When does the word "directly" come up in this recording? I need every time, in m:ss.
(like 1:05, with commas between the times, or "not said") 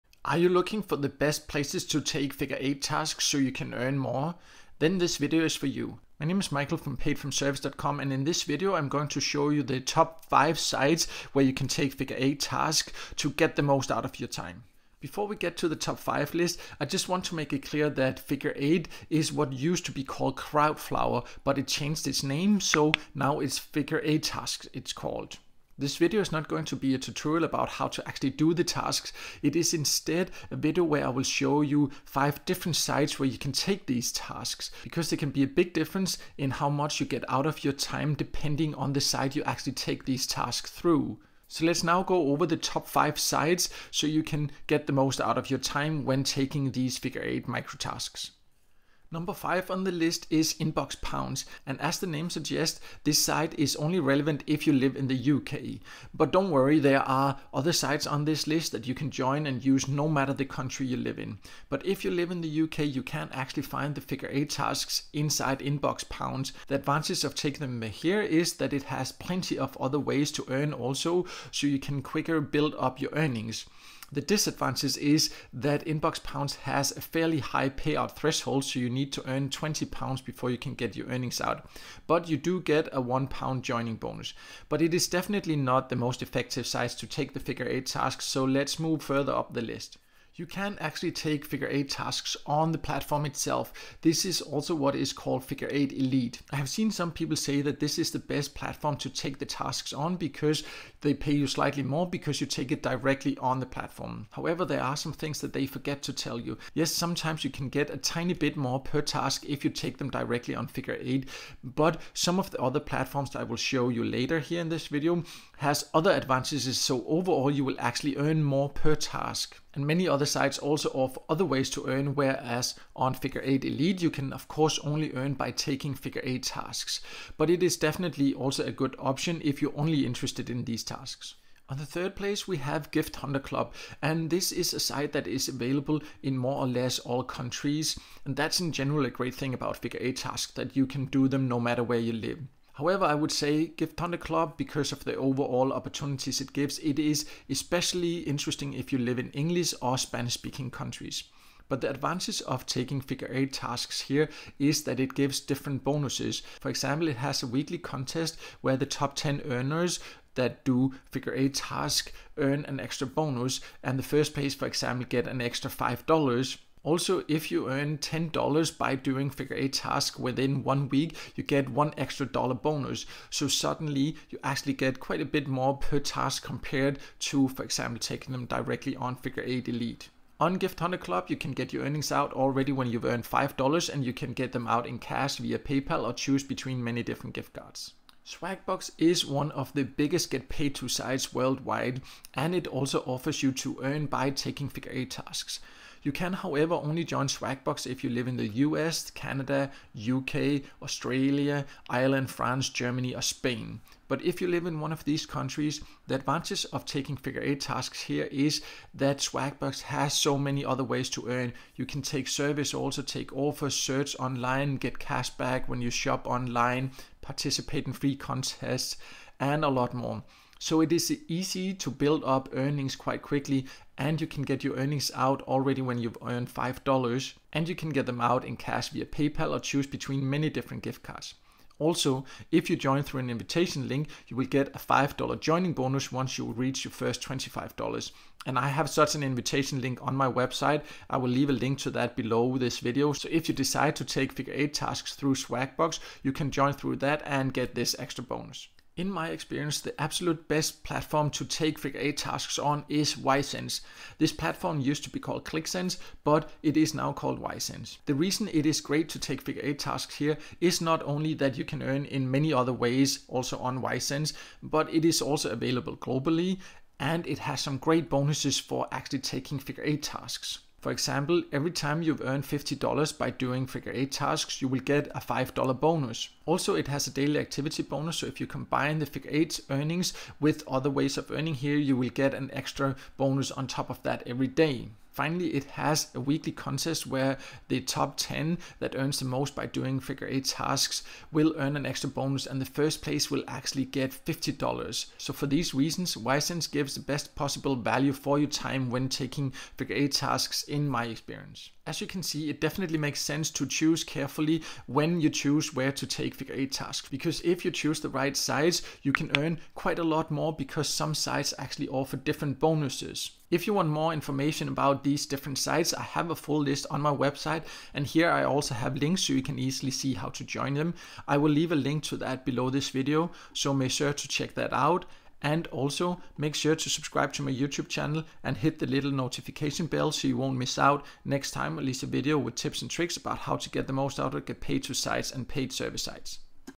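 1:42, 1:50, 2:58.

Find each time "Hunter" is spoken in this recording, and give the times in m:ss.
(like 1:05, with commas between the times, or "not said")
2:13, 2:23, 3:00.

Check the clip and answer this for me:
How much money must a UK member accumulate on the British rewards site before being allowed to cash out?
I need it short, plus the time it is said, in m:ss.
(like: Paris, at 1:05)
20 pounds, at 1:19.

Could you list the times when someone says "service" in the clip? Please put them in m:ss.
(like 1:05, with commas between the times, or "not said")
3:32, 5:35.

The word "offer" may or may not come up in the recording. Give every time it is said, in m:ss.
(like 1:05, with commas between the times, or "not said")
2:00, 3:13, 3:33, 5:11.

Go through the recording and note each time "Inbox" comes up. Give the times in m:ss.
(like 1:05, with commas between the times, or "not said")
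0:50, 1:05, 1:15.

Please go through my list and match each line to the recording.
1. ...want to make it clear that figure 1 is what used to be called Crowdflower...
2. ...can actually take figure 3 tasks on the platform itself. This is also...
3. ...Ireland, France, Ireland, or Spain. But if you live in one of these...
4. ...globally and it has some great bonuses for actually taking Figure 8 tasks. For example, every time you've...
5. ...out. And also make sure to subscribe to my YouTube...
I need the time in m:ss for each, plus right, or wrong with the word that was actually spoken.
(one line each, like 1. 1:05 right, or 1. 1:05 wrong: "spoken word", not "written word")
1. 0:17 wrong: "8", not "1"
2. 1:30 wrong: "8", not "3"
3. 3:21 wrong: "Germany", not "Ireland"
4. 4:25 right
5. 5:24 right.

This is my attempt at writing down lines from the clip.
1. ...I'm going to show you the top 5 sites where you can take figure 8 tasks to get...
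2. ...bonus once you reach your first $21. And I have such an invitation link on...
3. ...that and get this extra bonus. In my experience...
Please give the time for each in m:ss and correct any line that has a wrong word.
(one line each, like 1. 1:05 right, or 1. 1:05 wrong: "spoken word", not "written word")
1. 0:08 right
2. 3:55 wrong: "25", not "21"
3. 4:06 right.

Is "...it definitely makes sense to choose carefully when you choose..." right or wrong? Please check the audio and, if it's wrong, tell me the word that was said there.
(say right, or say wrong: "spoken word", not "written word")
right.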